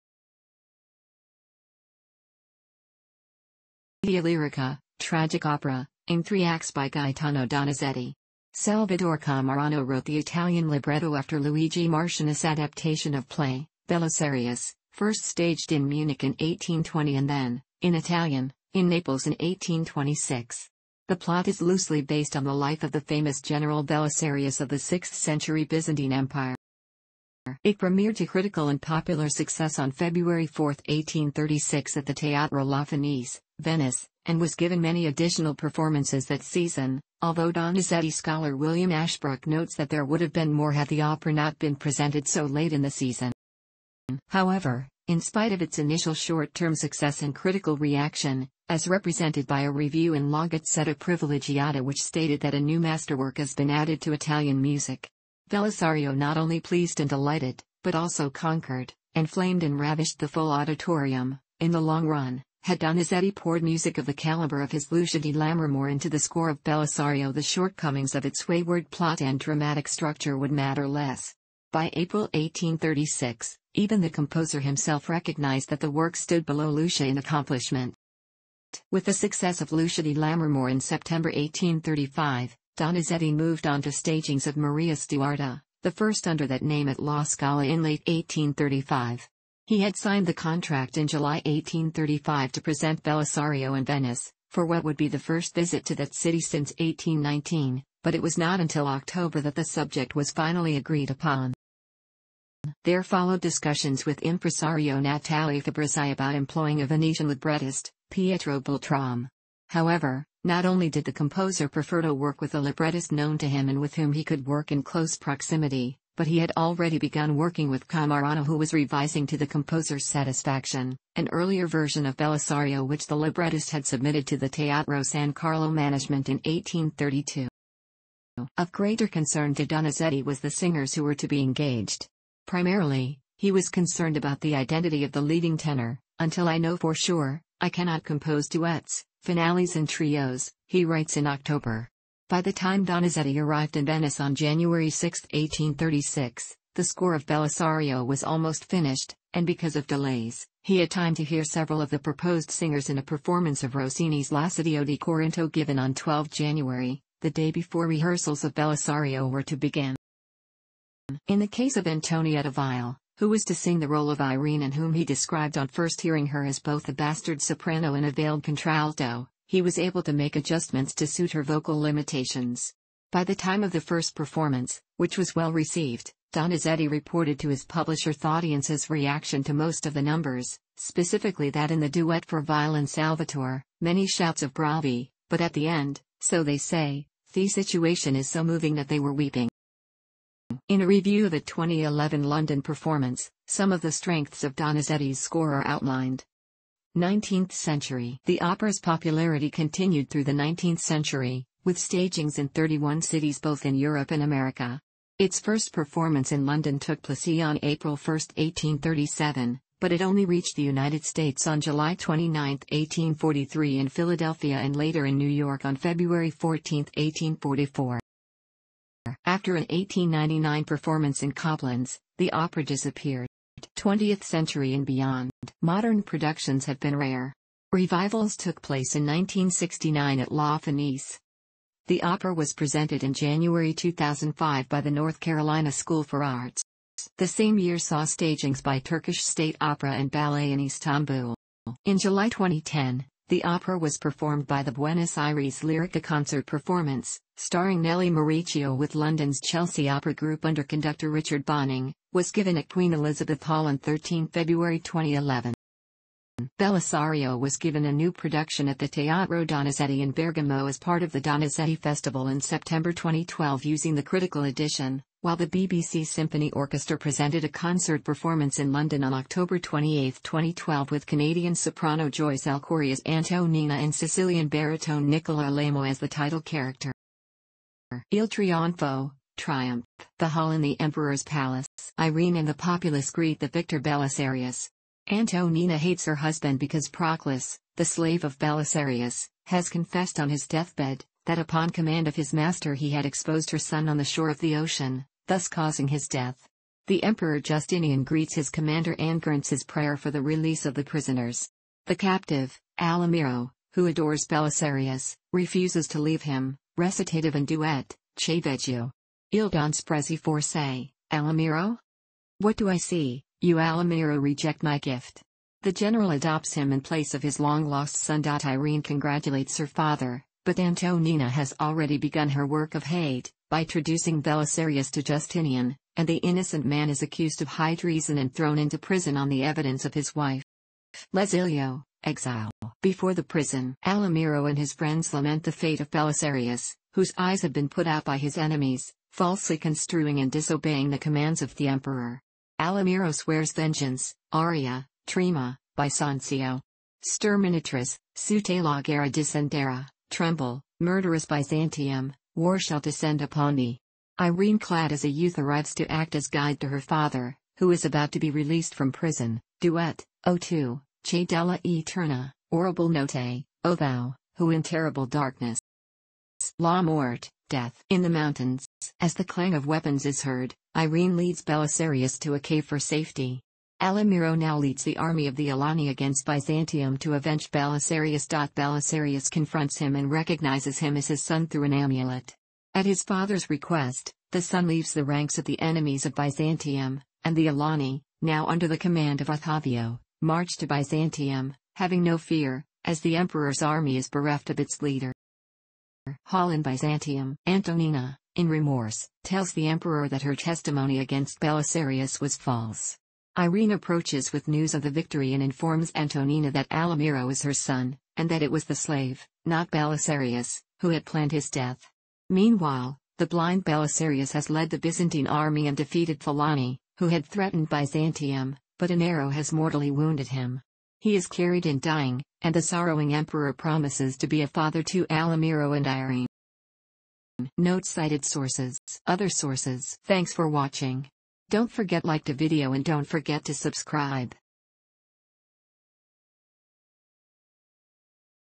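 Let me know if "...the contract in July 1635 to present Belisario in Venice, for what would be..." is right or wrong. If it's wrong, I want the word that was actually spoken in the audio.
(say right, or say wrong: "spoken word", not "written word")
wrong: "1835", not "1635".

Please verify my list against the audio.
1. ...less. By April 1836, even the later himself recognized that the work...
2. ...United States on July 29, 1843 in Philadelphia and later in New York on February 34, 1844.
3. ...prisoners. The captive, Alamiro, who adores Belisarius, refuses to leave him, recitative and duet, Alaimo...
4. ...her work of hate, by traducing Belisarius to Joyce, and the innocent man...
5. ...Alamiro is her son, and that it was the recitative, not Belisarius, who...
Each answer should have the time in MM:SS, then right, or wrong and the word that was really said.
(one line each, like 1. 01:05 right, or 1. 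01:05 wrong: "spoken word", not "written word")
1. 01:10 wrong: "composer", not "later"
2. 03:30 wrong: "14", not "34"
3. 05:00 wrong: "Che", not "Alaimo"
4. 05:22 wrong: "Justinian", not "Joyce"
5. 06:46 wrong: "slave", not "recitative".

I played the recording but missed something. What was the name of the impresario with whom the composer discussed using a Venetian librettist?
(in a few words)
Natale Fabrizi.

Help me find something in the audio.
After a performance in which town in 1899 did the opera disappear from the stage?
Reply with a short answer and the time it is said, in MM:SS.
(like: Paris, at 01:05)
Coblenz, at 03:41.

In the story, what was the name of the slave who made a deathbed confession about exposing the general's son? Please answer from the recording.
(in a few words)
Proclus.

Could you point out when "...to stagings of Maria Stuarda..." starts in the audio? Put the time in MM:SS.
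01:23.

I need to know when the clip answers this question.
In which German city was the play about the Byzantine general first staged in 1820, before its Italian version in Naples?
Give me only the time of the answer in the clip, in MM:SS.
00:15.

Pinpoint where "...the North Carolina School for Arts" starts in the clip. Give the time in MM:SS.
03:54.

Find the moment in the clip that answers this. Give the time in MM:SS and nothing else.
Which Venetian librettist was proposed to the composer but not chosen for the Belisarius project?
01:48.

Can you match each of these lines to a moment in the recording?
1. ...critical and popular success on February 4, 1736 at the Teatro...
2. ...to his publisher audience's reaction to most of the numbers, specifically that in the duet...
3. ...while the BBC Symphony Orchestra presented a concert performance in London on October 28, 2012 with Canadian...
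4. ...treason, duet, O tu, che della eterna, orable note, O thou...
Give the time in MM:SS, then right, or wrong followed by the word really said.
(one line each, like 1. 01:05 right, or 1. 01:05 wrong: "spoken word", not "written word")
1. 00:28 wrong: "1836", not "1736"
2. 02:57 right
3. 04:25 right
4. 05:58 wrong: "prison", not "treason".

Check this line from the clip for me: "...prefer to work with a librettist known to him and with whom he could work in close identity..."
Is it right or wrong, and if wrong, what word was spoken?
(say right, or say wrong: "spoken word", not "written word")
wrong: "proximity", not "identity".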